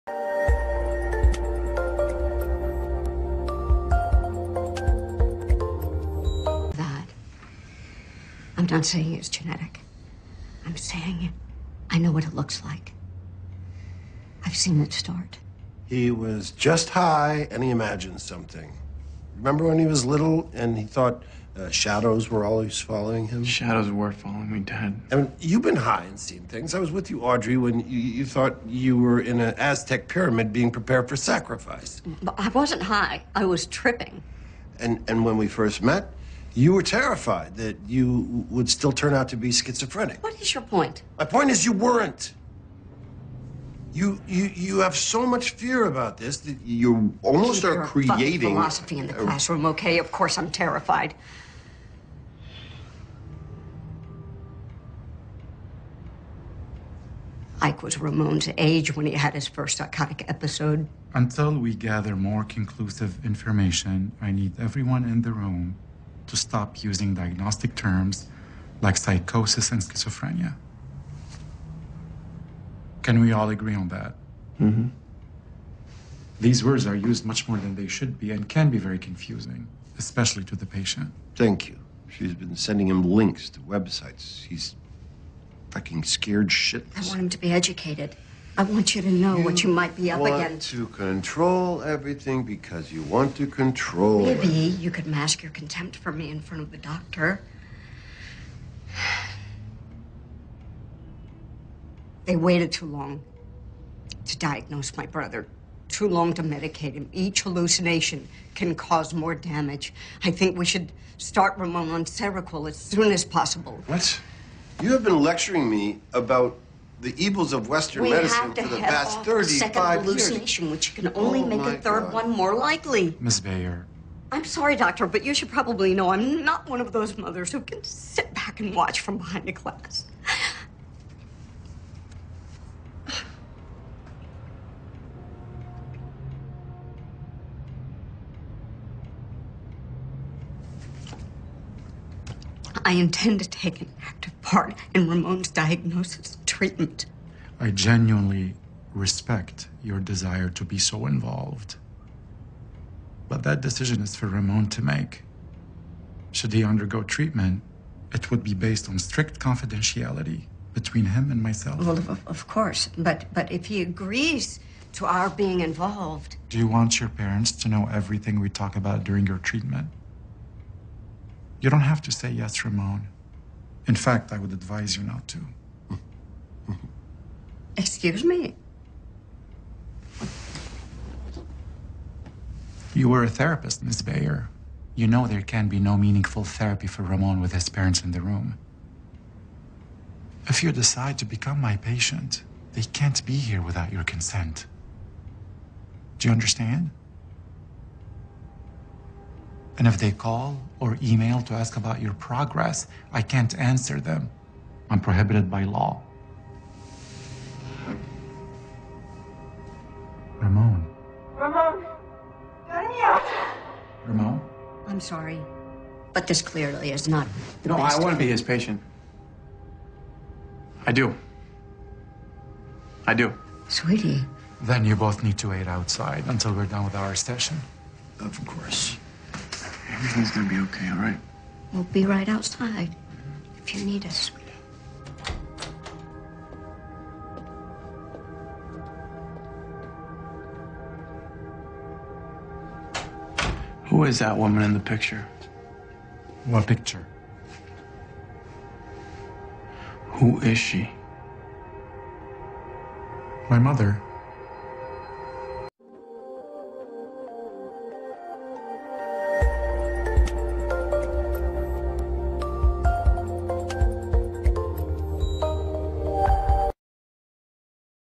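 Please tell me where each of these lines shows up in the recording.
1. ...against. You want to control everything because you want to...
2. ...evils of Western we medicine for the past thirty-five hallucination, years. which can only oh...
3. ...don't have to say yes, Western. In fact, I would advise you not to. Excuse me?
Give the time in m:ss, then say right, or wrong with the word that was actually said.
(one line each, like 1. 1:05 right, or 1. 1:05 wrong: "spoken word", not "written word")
1. 1:30 right
2. 1:57 right
3. 2:51 wrong: "Ramon", not "Western".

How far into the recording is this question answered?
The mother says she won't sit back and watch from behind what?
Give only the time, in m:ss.
2:09.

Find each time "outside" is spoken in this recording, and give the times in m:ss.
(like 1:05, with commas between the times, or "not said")
3:45, 3:52.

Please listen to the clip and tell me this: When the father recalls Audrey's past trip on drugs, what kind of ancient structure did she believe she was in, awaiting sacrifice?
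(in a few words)
Aztec pyramid.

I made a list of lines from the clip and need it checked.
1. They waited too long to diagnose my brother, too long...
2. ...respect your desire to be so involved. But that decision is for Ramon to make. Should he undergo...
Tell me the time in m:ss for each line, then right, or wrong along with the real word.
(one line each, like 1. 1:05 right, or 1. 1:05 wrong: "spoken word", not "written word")
1. 1:42 right
2. 2:28 right.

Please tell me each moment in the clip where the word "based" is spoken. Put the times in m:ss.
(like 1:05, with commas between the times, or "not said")
2:38.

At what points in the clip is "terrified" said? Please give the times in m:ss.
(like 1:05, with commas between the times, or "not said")
0:36, 0:50.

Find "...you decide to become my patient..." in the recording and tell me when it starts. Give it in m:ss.
3:10.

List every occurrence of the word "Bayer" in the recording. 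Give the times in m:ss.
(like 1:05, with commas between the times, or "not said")
2:03, 3:04.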